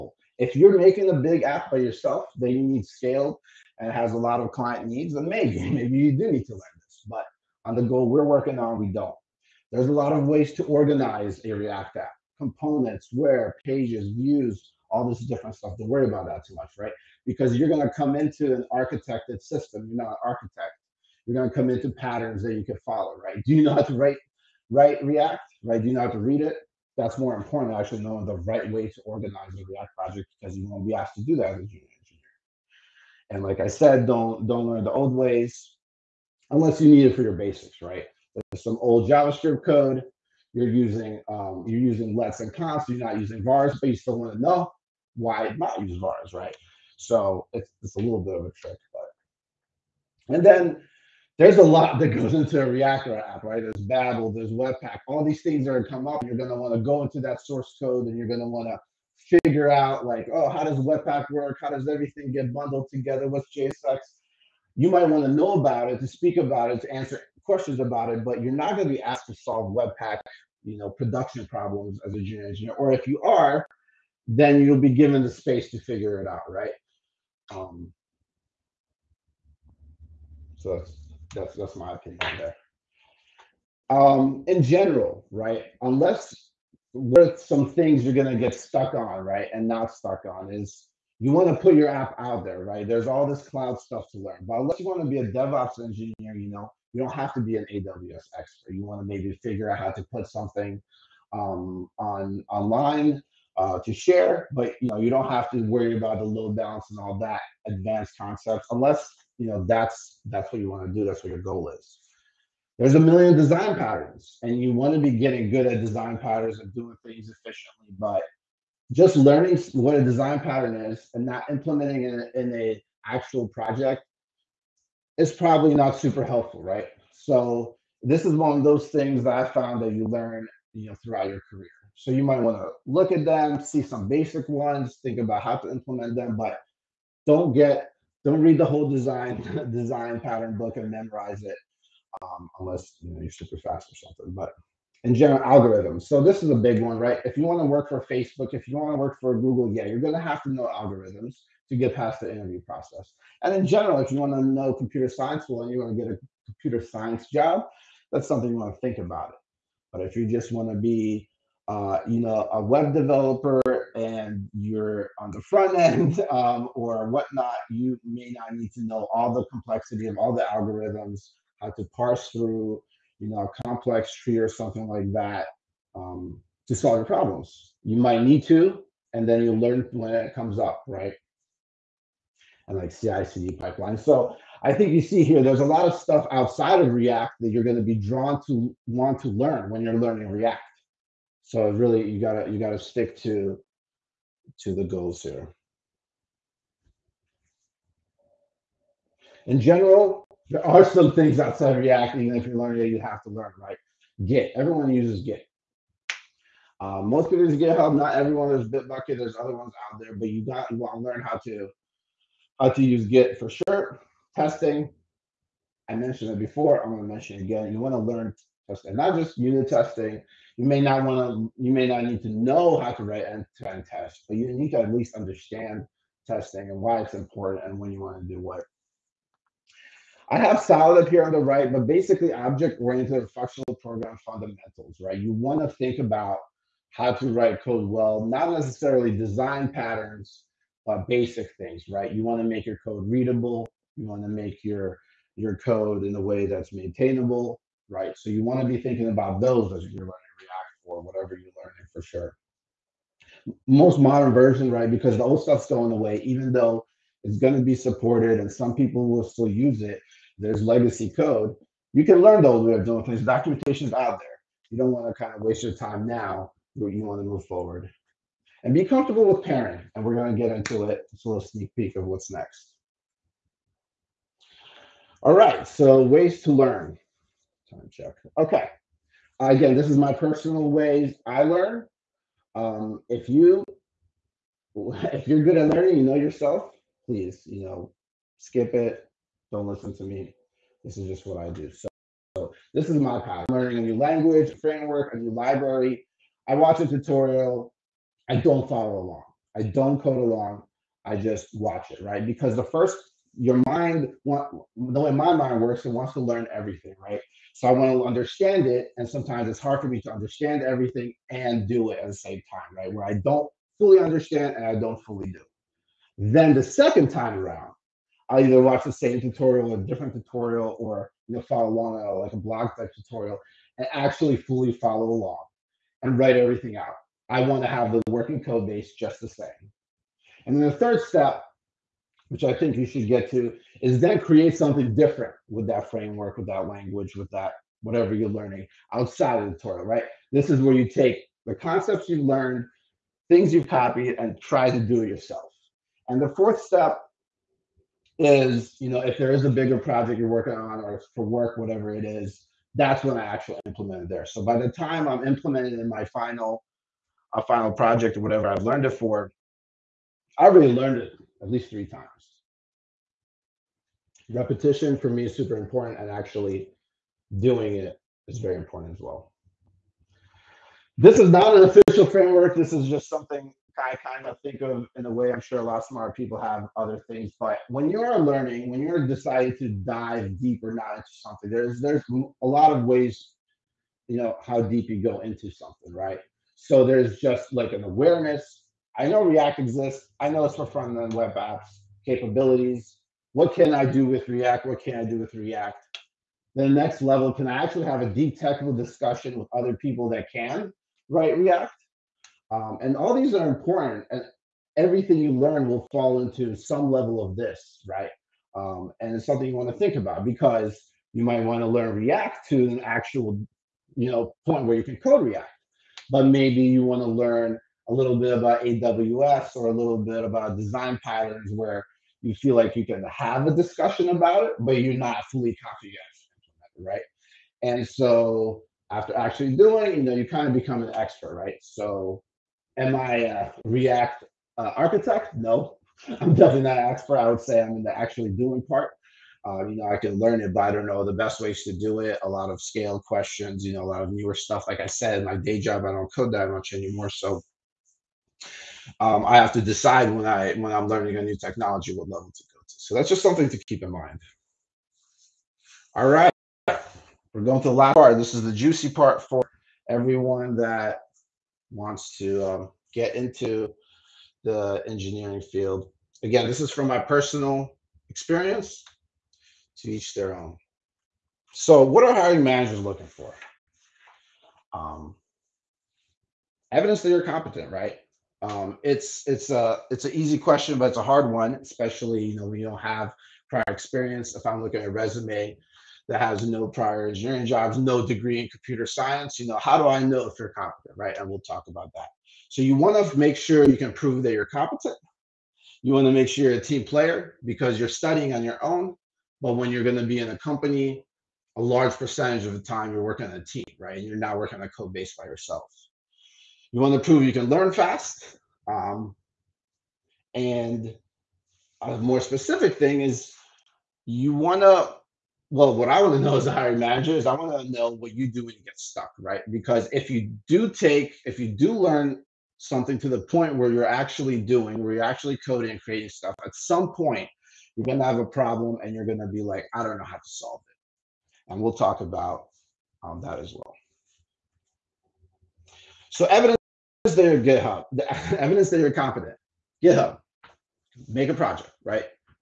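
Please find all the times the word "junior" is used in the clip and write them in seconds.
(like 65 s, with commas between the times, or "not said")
31 s, 72 s.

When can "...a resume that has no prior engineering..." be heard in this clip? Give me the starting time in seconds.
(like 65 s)
484 s.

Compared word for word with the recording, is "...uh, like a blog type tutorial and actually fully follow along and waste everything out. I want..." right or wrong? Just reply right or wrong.
wrong.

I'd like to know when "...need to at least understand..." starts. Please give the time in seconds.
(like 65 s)
224 s.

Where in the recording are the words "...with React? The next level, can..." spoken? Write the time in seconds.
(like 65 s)
395 s.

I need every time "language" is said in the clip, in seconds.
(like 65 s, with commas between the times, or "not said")
293 s, 336 s.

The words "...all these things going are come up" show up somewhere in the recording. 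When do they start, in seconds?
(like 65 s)
55 s.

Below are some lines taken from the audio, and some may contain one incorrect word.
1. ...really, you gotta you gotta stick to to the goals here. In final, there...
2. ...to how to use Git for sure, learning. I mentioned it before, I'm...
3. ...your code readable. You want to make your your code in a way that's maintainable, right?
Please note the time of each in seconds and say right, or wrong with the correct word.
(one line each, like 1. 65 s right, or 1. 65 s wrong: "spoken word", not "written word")
1. 191 s wrong: "general", not "final"
2. 211 s wrong: "testing", not "learning"
3. 242 s right.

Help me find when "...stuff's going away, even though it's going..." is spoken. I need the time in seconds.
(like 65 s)
255 s.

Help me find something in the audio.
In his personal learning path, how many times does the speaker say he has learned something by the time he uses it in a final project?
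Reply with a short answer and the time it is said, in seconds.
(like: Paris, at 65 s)
3, at 361 s.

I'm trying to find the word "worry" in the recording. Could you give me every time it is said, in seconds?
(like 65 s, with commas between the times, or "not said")
15 s, 105 s.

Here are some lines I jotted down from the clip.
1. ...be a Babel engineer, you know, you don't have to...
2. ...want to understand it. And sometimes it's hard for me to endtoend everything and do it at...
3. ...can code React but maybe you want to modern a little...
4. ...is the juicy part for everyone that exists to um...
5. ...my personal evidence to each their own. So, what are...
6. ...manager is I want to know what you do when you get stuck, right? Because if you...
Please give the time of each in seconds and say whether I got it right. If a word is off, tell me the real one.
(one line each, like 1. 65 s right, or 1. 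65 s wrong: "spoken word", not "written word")
1. 95 s wrong: "DevOps", not "Babel"
2. 307 s wrong: "understand", not "endtoend"
3. 414 s wrong: "learn", not "modern"
4. 458 s wrong: "wants", not "exists"
5. 466 s wrong: "experience", not "evidence"
6. 516 s right.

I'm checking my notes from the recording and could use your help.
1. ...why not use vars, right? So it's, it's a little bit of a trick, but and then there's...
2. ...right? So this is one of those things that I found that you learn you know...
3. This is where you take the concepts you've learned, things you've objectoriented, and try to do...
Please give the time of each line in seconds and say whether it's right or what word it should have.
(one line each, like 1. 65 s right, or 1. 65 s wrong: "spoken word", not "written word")
1. 45 s right
2. 126 s right
3. 340 s wrong: "copied", not "objectoriented".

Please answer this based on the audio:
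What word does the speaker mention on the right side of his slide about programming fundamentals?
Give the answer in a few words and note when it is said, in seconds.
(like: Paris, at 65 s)
solid, at 230 s.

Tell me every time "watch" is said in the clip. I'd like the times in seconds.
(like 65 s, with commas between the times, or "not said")
296 s, 301 s, 318 s.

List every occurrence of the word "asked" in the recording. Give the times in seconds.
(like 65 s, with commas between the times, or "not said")
30 s, 69 s.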